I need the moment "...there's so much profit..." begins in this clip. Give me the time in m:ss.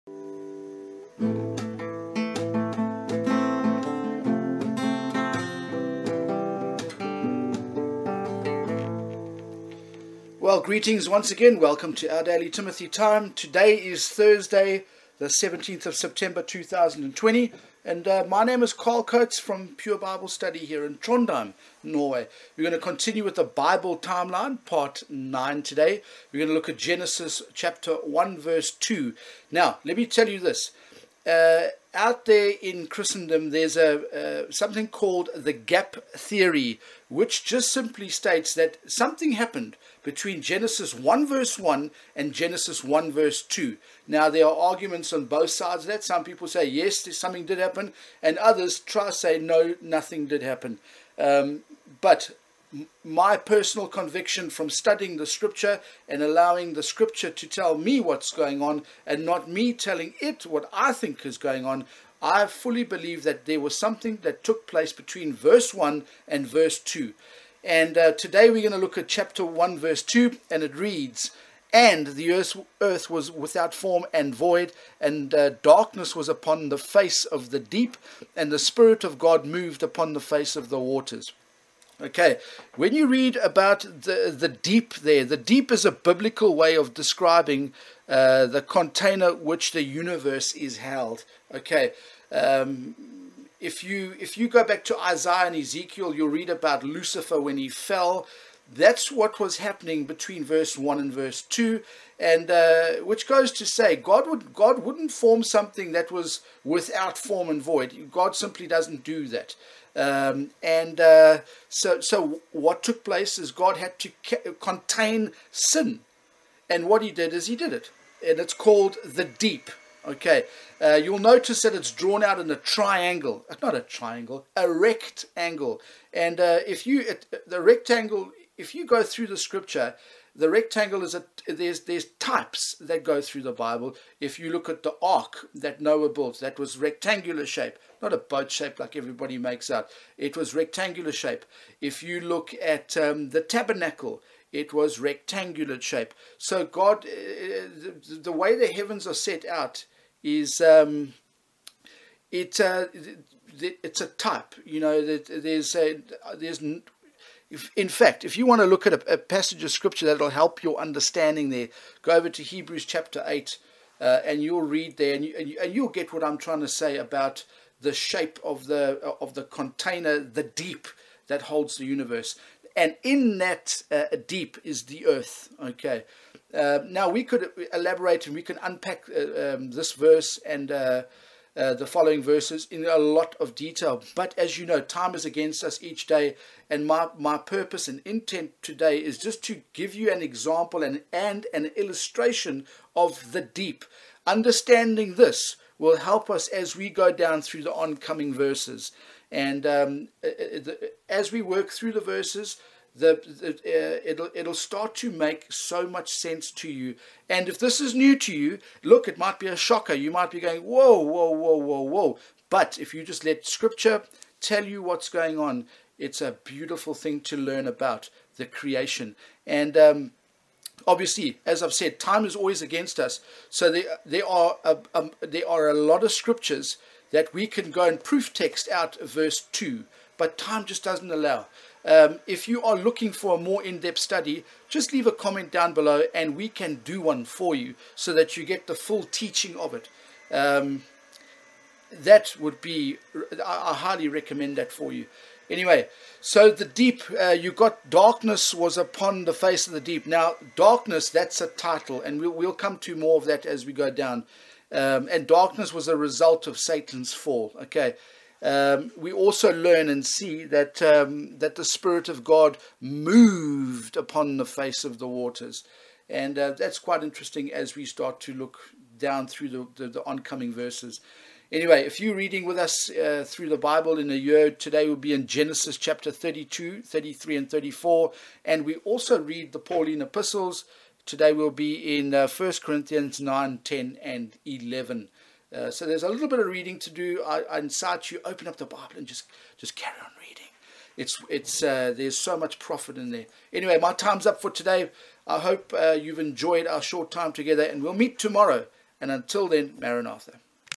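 4:51.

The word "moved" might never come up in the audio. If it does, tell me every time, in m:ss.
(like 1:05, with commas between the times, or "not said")
1:19, 4:22.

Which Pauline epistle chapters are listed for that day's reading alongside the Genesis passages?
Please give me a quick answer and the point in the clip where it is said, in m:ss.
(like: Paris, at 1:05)
1 Corinthians 9, 10, and 11, at 4:42.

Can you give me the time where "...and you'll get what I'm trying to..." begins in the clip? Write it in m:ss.
2:45.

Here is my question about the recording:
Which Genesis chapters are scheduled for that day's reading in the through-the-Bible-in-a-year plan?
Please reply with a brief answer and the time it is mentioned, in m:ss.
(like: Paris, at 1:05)
32, 33, and 34, at 4:35.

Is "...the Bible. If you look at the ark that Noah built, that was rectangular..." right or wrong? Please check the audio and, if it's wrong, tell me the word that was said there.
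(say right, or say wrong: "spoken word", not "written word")
right.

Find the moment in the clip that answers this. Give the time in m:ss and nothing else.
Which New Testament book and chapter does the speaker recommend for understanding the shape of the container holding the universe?
2:42.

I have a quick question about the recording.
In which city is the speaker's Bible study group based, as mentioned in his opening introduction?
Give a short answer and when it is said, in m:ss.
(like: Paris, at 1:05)
Trondheim, at 0:20.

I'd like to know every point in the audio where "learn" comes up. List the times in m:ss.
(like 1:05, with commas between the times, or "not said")
3:37, 4:19.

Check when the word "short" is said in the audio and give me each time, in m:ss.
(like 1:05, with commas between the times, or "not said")
4:56.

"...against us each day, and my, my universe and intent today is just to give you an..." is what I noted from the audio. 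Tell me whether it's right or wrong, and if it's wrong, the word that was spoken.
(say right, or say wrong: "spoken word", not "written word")
wrong: "purpose", not "universe".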